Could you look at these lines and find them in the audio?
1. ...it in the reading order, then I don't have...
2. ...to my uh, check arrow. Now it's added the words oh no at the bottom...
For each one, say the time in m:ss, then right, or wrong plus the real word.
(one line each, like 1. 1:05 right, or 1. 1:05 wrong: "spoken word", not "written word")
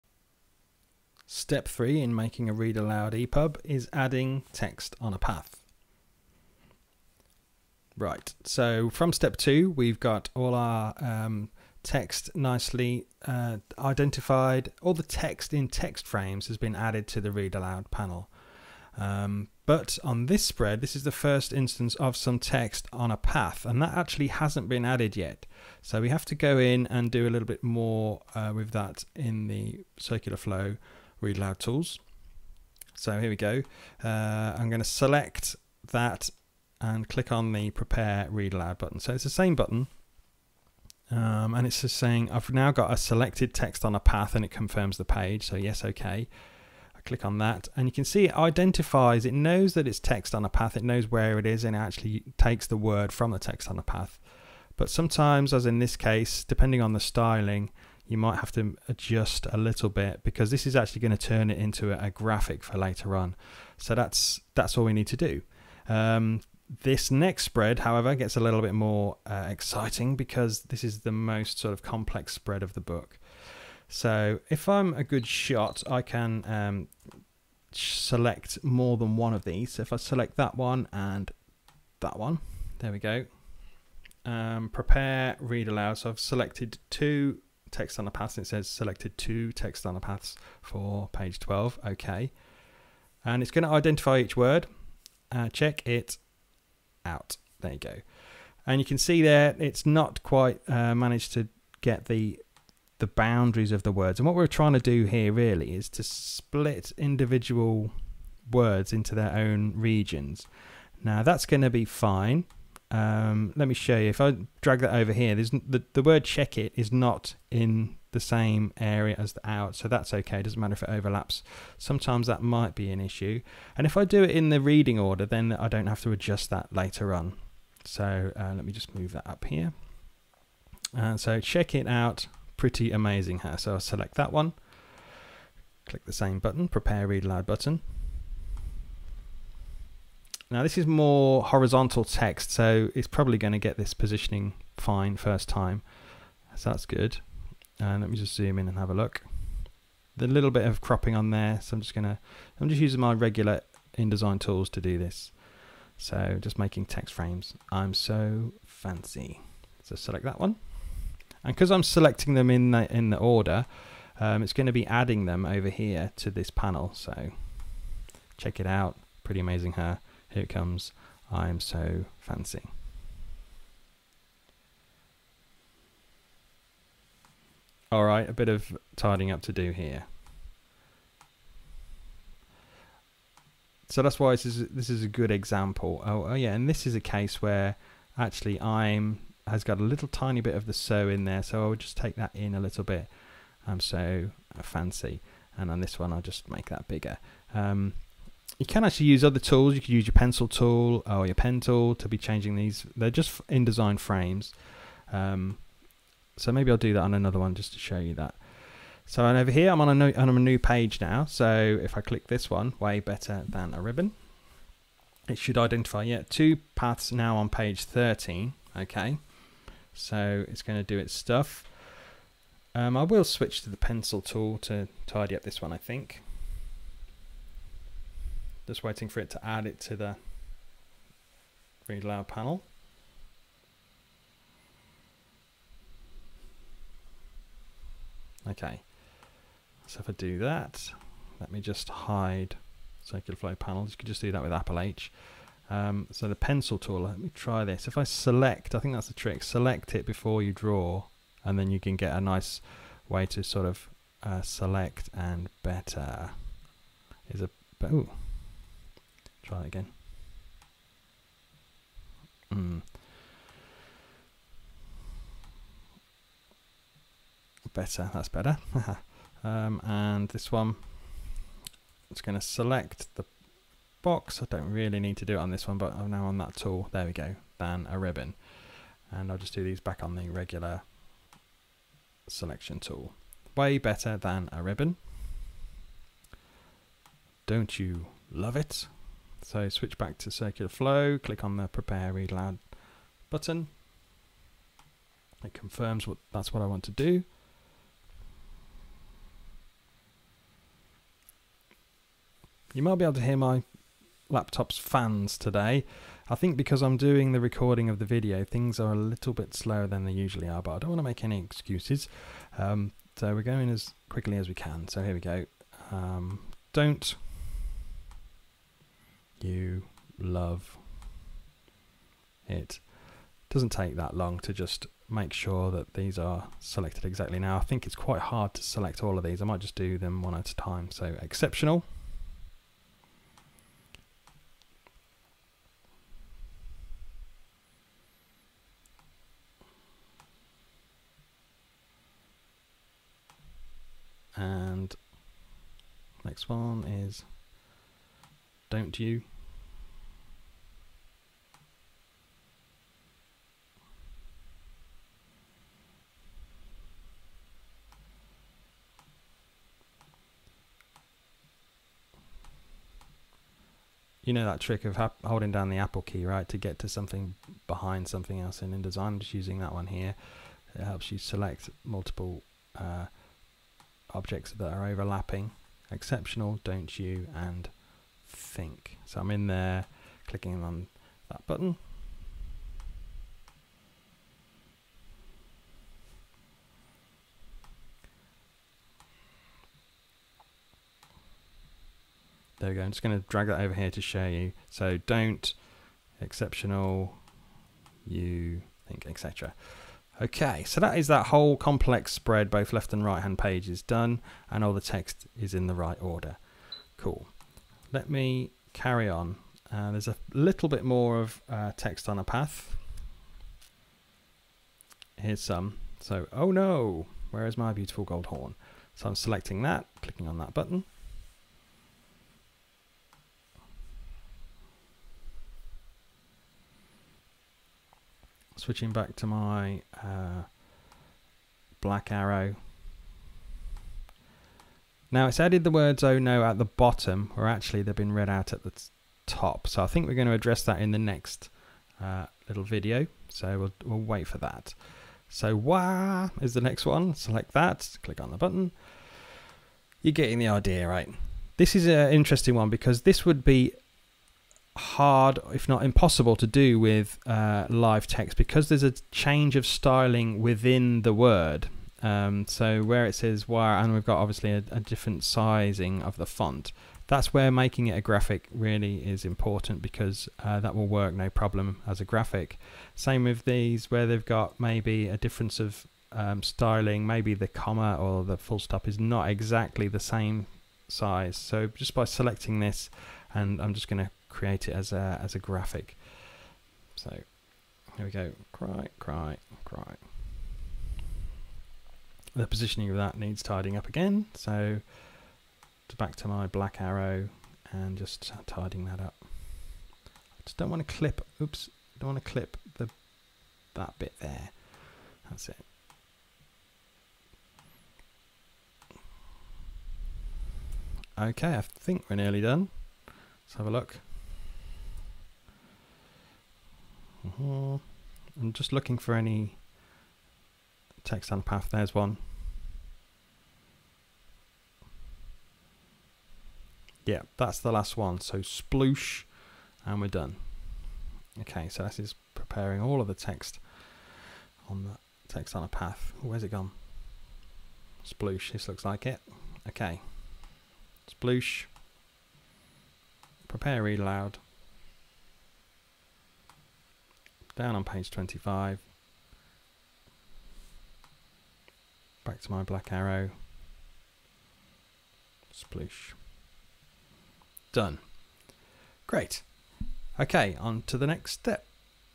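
1. 2:04 right
2. 7:09 wrong: "black", not "check".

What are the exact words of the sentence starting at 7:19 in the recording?
So I think we're going to address that in the next uh, little video.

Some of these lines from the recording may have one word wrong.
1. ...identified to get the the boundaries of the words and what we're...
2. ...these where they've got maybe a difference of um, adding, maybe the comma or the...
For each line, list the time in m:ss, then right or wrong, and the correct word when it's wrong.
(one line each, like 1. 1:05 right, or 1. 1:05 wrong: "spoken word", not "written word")
1. 1:40 wrong: "managed", not "identified"
2. 7:53 wrong: "styling", not "adding".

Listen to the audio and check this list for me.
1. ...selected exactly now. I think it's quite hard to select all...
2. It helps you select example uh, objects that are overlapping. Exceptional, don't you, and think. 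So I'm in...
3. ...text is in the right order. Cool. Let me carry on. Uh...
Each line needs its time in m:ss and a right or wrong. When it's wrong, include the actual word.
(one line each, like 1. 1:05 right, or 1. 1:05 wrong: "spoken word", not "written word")
1. 5:26 right
2. 6:10 wrong: "multiple", not "example"
3. 6:44 right.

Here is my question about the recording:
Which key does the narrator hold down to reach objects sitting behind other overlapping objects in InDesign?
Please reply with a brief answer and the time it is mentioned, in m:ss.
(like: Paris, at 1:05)
Apple key, at 6:05.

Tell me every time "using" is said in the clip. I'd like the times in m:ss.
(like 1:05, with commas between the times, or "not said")
2:32, 6:09.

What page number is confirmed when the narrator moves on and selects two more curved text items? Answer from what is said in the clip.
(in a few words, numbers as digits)
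13.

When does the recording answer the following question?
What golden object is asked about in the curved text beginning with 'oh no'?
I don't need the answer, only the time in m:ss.
6:58.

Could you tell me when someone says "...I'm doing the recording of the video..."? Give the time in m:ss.
5:06.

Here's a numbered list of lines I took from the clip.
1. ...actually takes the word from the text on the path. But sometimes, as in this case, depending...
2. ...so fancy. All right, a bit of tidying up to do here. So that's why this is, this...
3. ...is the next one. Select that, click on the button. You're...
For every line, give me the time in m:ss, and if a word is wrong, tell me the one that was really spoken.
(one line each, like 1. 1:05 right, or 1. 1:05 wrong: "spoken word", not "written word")
1. 0:51 right
2. 2:51 right
3. 7:26 right.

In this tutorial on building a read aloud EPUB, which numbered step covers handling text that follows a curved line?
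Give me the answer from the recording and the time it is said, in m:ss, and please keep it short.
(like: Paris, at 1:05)
Step three, at 0:01.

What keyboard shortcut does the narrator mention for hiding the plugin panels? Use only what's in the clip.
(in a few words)
Apple H.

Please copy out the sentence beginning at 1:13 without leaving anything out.
So if I'm a good shot, I can um, select more than one of these.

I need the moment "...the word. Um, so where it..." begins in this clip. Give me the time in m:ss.
7:41.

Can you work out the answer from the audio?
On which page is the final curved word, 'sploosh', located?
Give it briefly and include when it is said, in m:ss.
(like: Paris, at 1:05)
25, at 9:07.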